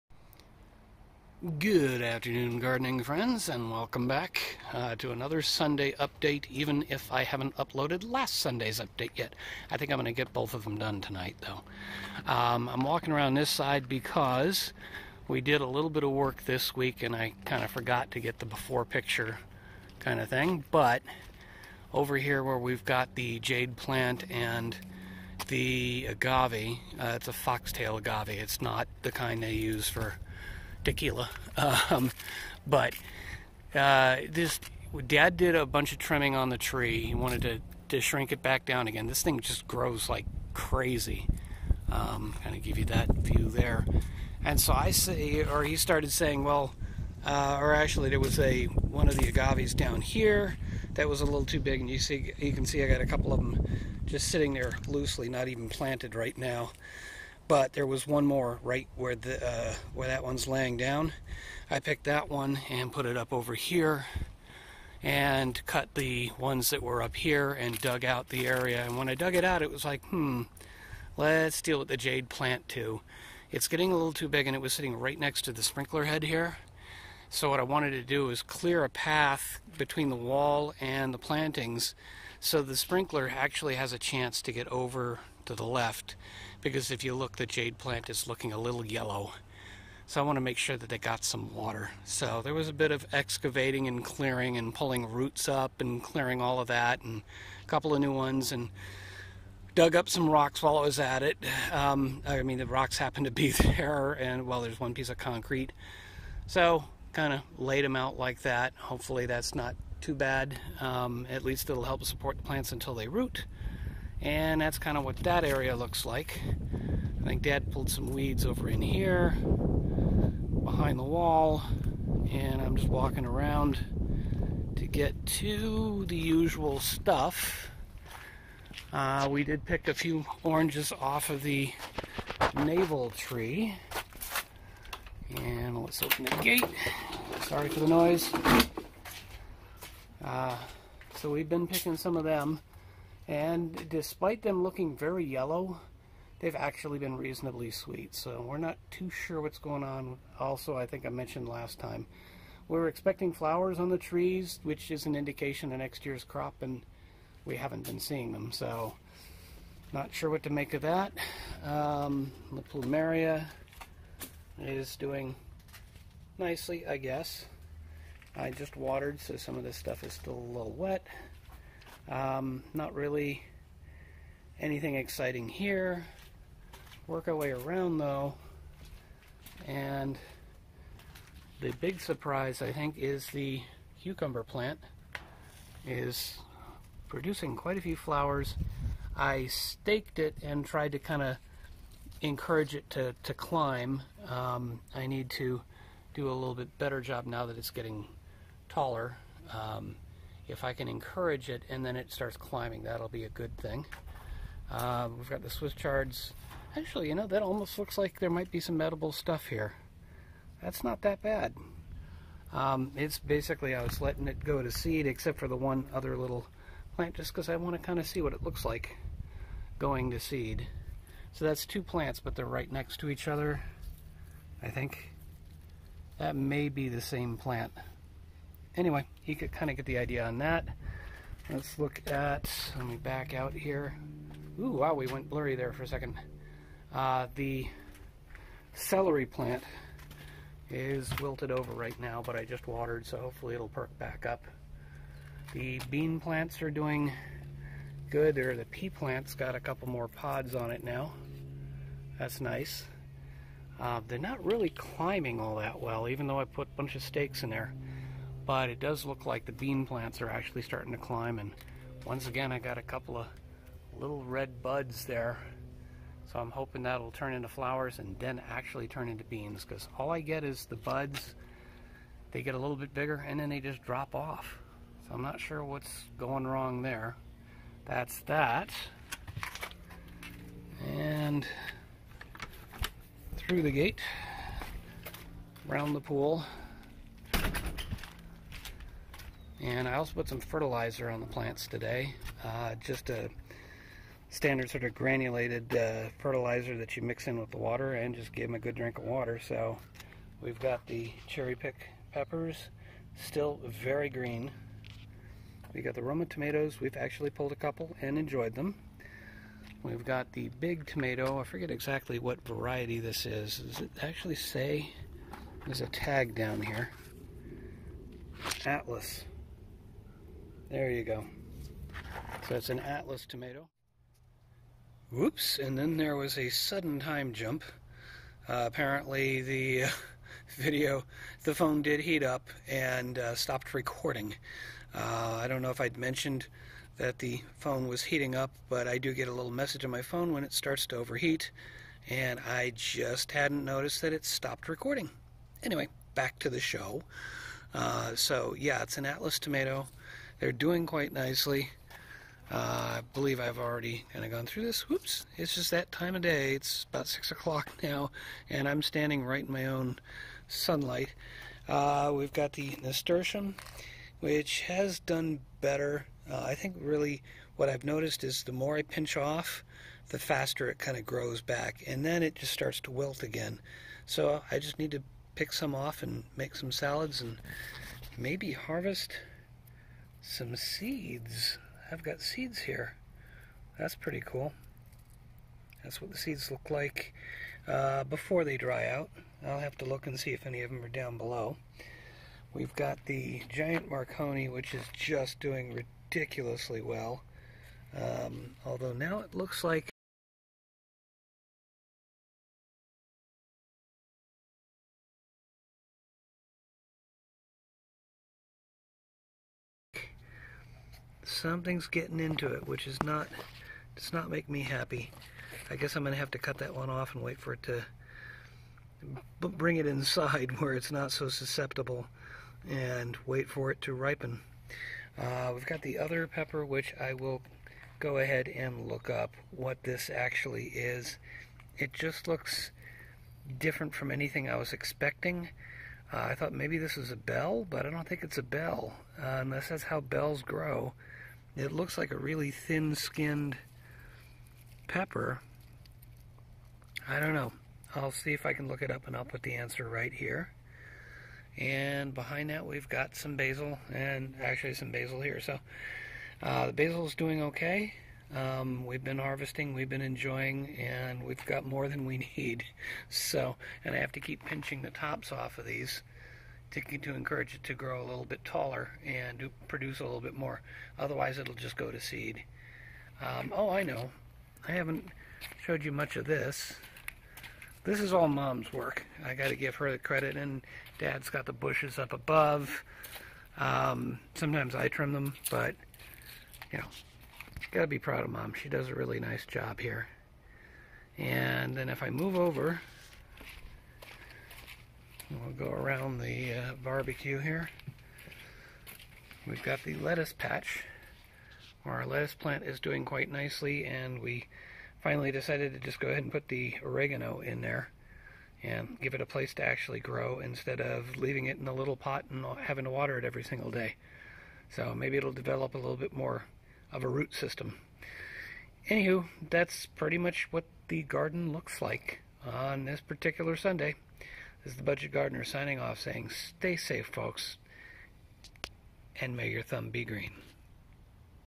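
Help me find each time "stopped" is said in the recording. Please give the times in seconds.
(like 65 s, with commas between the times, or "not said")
333 s, 344 s.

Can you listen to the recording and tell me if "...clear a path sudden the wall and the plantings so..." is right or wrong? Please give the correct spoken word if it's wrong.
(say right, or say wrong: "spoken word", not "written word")
wrong: "between", not "sudden".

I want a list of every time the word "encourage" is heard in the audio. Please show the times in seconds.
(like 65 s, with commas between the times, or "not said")
192 s, 200 s, 467 s.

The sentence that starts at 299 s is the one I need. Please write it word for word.
So we've got the cherry pick peppers, still very green.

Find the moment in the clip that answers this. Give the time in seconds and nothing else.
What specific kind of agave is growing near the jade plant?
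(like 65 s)
27 s.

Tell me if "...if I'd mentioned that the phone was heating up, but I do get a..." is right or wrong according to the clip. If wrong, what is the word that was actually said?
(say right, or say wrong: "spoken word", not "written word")
right.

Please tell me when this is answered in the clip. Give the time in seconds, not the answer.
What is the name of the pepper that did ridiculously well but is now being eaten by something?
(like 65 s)
393 s.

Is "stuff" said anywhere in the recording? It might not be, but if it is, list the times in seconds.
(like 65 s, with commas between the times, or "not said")
126 s, 169 s, 209 s.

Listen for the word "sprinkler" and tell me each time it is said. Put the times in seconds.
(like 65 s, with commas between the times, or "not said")
75 s, 82 s.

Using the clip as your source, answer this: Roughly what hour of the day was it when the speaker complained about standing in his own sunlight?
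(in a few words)
6 o'clock.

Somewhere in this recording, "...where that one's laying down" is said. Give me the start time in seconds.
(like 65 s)
59 s.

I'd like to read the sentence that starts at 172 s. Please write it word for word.
Um, not really anything exciting here.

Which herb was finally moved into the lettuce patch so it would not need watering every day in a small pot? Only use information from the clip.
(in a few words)
Oregano.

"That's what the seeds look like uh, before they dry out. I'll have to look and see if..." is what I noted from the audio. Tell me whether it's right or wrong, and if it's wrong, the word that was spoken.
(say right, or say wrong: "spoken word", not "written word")
right.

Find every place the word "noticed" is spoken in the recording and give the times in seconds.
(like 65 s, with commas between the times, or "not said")
343 s, 367 s.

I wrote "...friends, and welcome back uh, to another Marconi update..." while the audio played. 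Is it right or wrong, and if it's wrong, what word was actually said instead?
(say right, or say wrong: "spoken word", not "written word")
wrong: "Sunday", not "Marconi".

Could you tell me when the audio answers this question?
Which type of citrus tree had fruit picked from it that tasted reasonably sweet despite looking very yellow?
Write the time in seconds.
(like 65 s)
132 s.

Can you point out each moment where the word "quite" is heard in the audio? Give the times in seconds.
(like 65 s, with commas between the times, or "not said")
187 s, 350 s, 503 s.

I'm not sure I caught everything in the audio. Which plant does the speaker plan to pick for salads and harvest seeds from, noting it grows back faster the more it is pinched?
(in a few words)
Nasturtium.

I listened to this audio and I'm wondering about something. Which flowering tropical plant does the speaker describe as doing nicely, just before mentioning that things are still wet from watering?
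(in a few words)
Plumeria.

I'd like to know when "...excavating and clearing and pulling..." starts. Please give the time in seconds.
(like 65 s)
93 s.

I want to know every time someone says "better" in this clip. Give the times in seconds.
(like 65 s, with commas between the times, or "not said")
196 s, 365 s.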